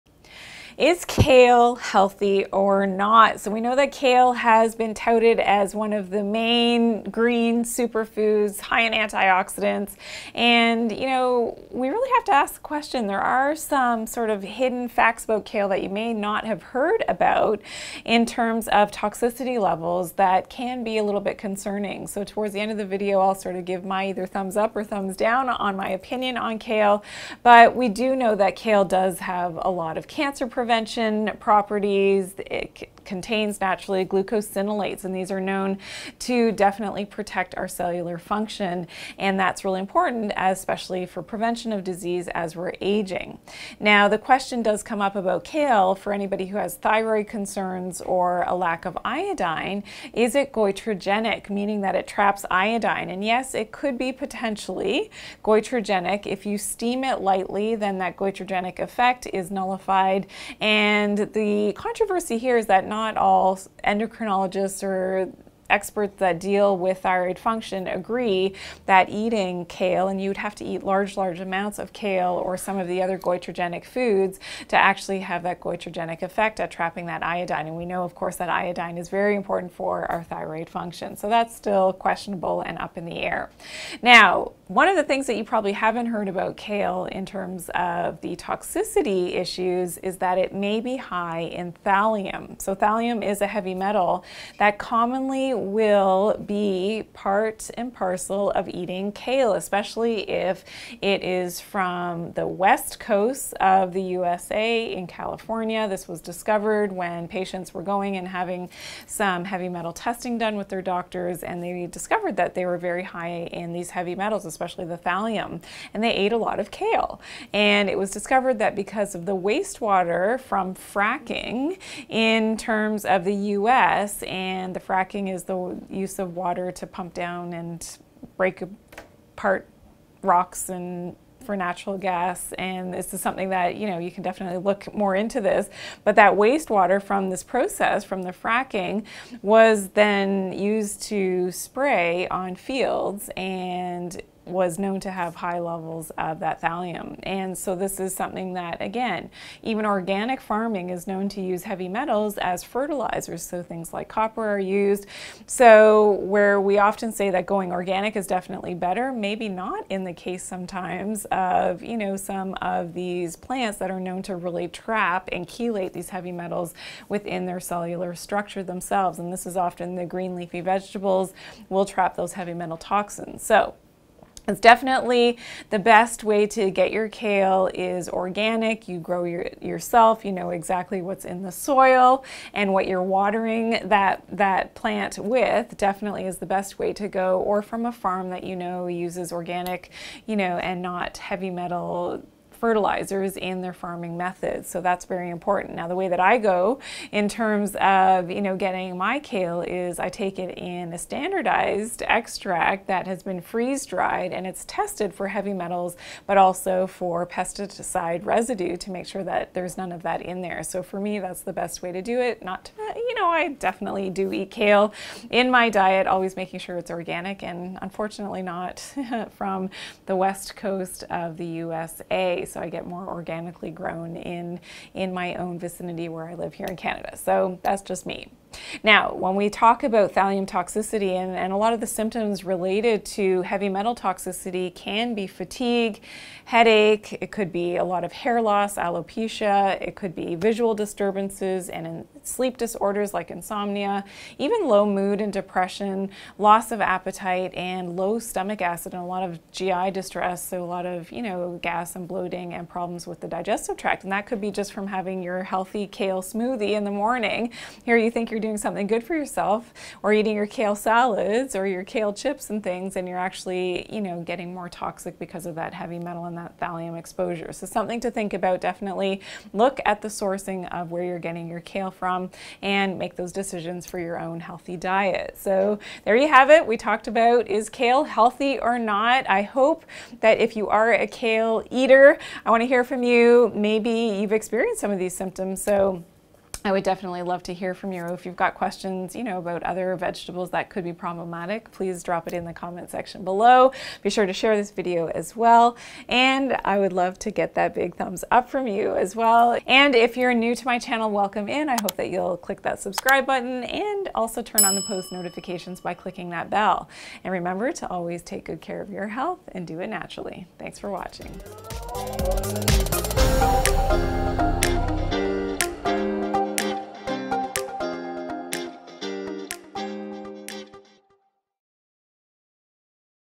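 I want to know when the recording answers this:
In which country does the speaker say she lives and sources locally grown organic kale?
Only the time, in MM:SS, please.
03:46.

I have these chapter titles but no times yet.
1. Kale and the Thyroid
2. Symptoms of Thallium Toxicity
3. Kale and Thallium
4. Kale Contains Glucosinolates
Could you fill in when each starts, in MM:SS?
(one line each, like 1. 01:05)
1. 00:45
2. 03:50
3. 01:24
4. 00:28.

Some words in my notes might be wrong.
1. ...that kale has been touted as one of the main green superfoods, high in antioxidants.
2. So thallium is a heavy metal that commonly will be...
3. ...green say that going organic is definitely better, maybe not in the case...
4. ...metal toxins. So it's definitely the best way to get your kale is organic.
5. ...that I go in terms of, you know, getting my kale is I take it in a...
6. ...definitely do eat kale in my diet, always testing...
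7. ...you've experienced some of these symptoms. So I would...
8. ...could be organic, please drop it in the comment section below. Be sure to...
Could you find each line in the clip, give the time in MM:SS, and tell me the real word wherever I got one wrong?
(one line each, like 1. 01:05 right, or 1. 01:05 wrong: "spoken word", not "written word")
1. 00:03 right
2. 01:32 right
3. 02:36 wrong: "often", not "green"
4. 02:52 right
5. 03:16 right
6. 03:33 wrong: "making", not "testing"
7. 04:43 right
8. 04:50 wrong: "problematic", not "organic".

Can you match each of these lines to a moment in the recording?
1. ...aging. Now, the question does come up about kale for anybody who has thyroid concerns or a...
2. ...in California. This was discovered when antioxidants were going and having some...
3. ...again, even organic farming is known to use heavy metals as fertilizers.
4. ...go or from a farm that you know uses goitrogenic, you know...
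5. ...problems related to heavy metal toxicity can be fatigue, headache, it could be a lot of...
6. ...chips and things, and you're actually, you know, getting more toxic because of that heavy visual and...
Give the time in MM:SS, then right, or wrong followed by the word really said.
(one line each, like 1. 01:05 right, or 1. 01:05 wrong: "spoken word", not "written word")
1. 00:42 right
2. 01:44 wrong: "patients", not "antioxidants"
3. 02:28 right
4. 03:07 wrong: "organic", not "goitrogenic"
5. 03:51 wrong: "symptoms", not "problems"
6. 04:22 wrong: "metal", not "visual".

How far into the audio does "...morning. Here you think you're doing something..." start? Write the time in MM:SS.
04:16.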